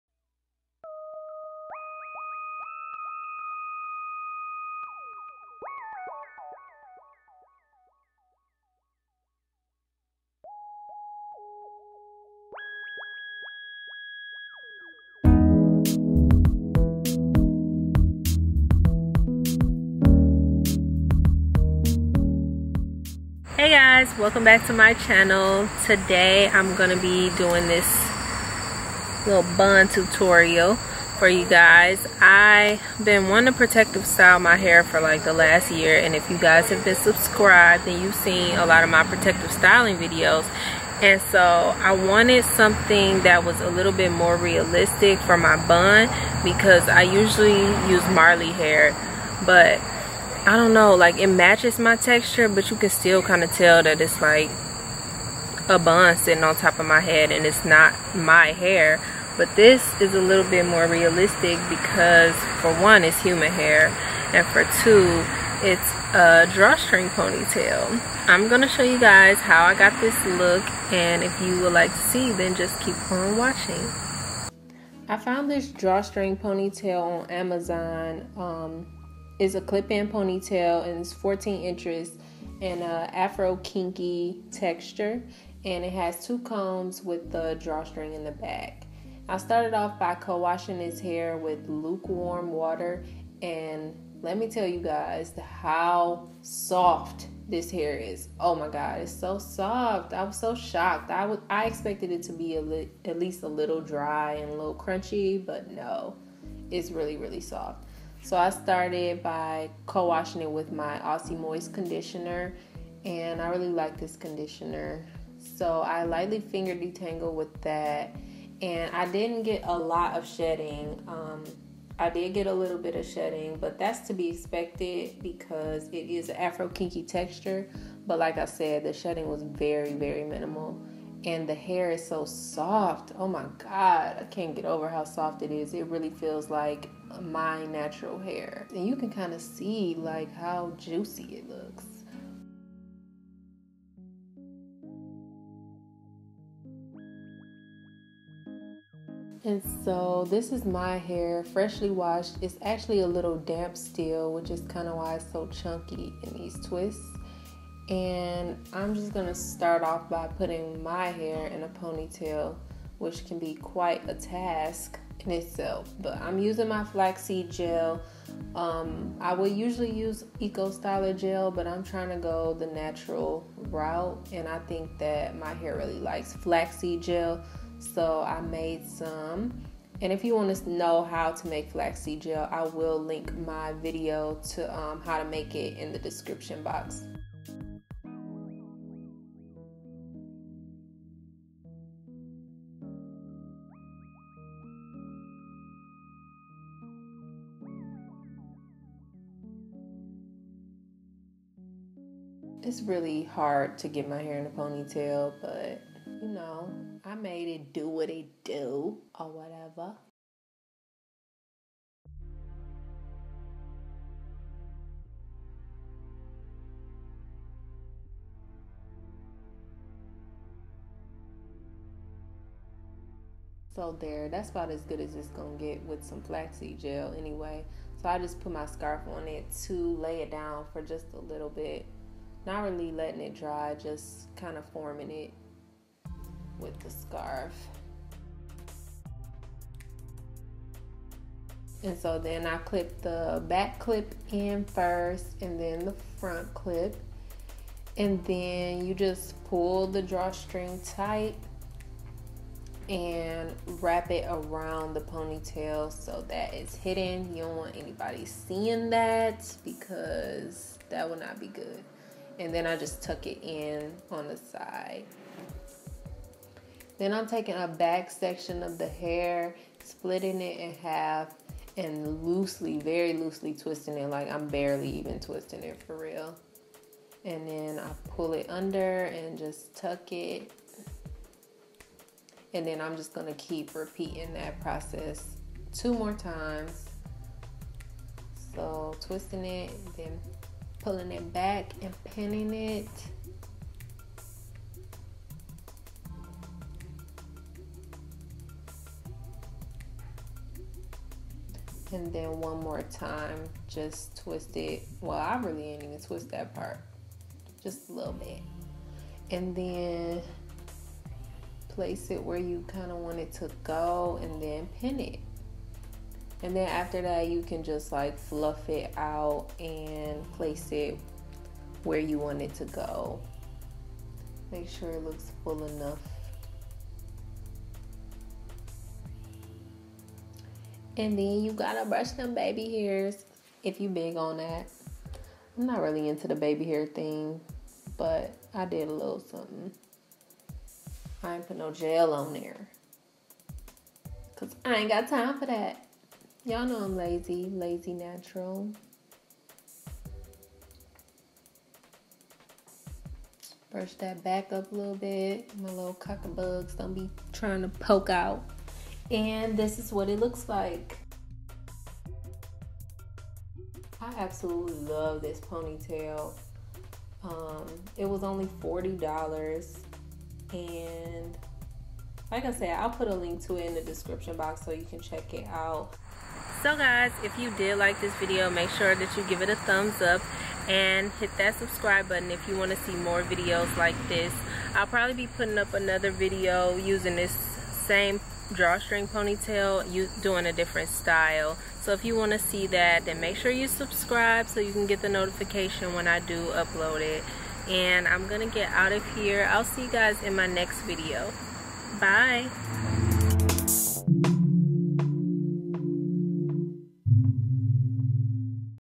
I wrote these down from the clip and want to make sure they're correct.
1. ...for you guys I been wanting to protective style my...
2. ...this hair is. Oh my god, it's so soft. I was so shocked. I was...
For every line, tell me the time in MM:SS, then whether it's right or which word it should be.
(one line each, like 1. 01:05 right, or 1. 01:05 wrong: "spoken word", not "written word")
1. 00:31 right
2. 01:37 right.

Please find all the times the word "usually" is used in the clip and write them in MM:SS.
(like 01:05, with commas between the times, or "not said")
00:47, 02:49.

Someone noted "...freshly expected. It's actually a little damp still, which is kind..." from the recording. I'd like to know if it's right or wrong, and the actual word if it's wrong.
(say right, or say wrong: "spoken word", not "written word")
wrong: "washed", not "expected".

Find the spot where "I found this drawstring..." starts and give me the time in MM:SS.
01:15.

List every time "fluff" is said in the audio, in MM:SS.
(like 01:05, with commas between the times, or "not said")
05:18.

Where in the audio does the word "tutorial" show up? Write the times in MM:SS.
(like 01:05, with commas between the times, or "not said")
00:29.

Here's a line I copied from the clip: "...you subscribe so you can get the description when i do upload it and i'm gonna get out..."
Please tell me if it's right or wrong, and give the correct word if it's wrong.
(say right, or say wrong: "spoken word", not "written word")
wrong: "notification", not "description".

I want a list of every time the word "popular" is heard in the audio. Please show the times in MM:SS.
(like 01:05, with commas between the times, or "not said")
not said.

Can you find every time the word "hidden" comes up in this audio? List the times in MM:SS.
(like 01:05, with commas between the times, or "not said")
04:16.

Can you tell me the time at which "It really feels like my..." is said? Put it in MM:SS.
02:15.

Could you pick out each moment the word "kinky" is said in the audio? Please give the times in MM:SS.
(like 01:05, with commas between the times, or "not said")
01:23, 02:06.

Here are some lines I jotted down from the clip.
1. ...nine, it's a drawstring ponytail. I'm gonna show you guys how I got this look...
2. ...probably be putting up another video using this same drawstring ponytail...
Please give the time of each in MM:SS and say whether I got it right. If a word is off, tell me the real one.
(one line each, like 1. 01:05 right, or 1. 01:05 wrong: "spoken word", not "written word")
1. 01:04 wrong: "two", not "nine"
2. 06:24 right.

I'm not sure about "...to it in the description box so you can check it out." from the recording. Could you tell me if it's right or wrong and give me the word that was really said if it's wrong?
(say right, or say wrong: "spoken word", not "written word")
right.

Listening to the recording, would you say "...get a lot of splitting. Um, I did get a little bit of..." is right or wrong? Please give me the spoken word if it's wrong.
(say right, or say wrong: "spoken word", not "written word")
wrong: "shedding", not "splitting".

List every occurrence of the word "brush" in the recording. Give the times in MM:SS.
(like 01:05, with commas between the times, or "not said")
05:31, 05:53.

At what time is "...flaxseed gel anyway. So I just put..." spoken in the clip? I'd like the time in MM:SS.
03:46.